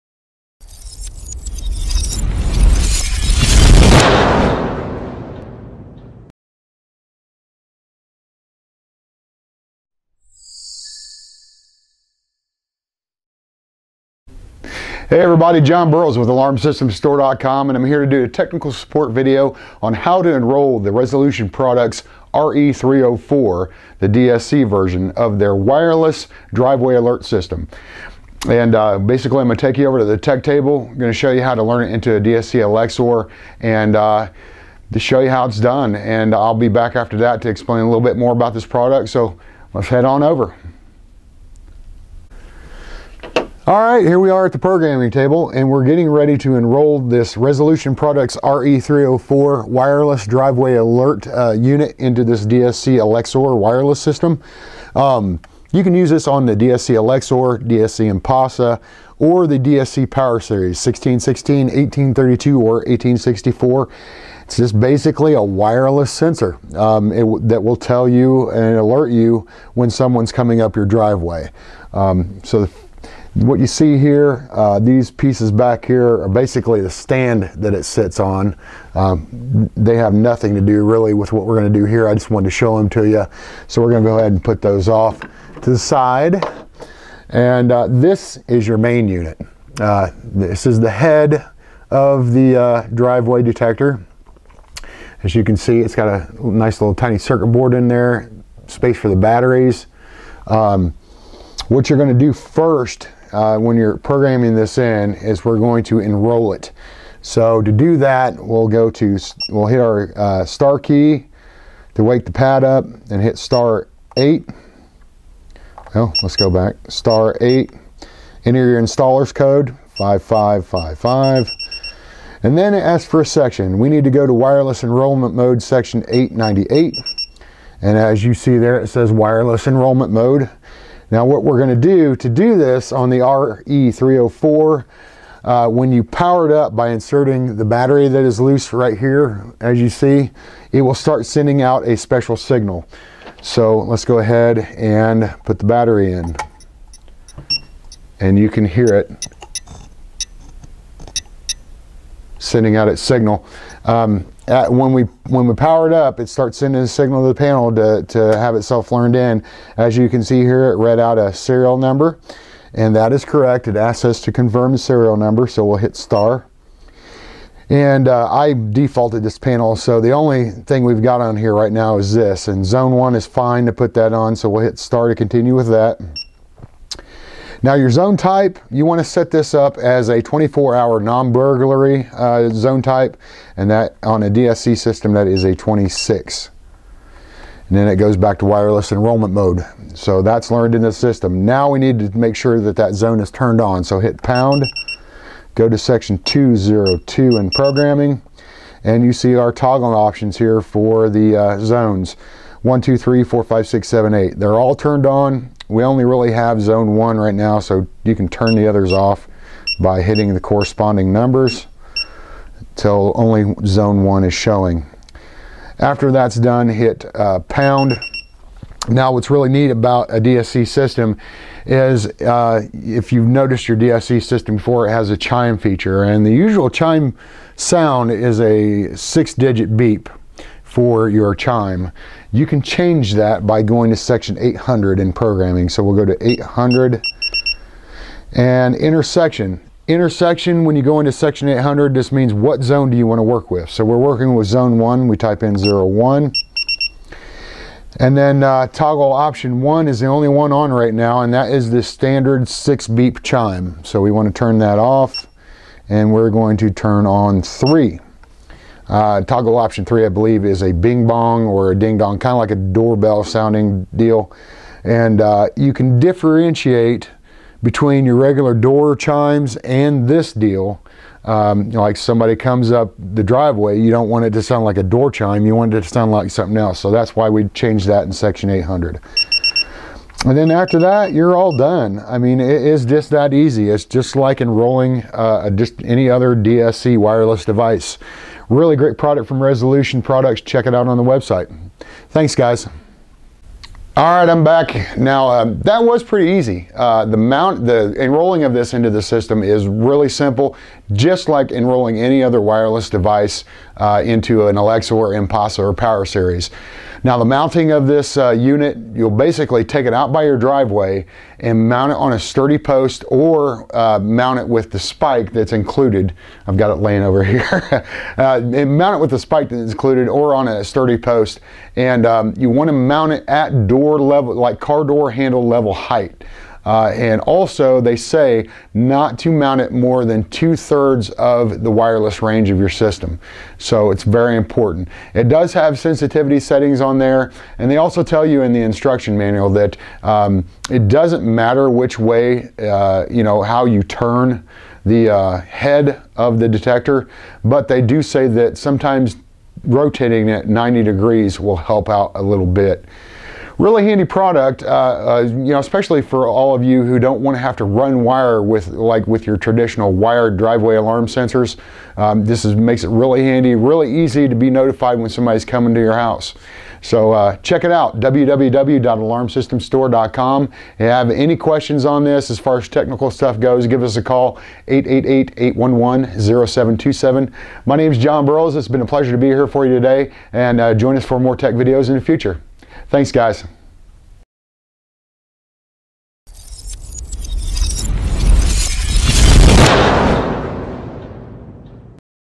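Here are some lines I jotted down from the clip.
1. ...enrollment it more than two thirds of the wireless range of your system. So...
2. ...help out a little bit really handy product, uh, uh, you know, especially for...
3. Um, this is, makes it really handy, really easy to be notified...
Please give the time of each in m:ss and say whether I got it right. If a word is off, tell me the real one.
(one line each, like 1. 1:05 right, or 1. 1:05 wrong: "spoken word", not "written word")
1. 5:29 wrong: "mount", not "enrollment"
2. 5:51 right
3. 6:01 right.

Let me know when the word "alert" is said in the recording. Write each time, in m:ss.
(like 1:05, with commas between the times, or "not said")
0:26, 0:50, 1:08.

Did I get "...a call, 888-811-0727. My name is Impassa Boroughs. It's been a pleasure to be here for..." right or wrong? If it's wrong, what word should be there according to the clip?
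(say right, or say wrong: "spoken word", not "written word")
wrong: "Jon", not "Impassa".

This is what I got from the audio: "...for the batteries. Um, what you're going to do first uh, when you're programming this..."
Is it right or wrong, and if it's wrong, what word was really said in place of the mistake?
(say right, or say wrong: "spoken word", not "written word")
right.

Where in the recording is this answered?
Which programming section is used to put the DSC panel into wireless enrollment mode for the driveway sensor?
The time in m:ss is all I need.
2:05.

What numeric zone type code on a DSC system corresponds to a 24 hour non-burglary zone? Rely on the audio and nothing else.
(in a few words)
26.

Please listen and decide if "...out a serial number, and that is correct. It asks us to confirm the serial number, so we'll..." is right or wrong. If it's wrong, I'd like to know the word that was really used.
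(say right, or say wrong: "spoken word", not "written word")
right.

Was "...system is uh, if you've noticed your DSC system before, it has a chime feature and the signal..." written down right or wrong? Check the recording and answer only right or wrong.
wrong.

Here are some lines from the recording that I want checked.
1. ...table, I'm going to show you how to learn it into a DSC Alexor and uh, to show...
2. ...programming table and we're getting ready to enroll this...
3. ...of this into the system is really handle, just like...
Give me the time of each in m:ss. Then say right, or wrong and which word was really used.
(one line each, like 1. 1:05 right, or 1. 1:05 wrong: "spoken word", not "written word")
1. 0:30 right
2. 0:44 right
3. 4:58 wrong: "simple", not "handle".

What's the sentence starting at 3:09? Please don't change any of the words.
So that's learned in the system.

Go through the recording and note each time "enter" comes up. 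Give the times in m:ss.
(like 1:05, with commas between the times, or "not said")
1:58.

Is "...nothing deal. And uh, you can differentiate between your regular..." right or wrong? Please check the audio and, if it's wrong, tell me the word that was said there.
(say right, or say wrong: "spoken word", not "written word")
wrong: "sounding", not "nothing".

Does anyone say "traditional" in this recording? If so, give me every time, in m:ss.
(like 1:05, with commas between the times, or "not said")
5:59.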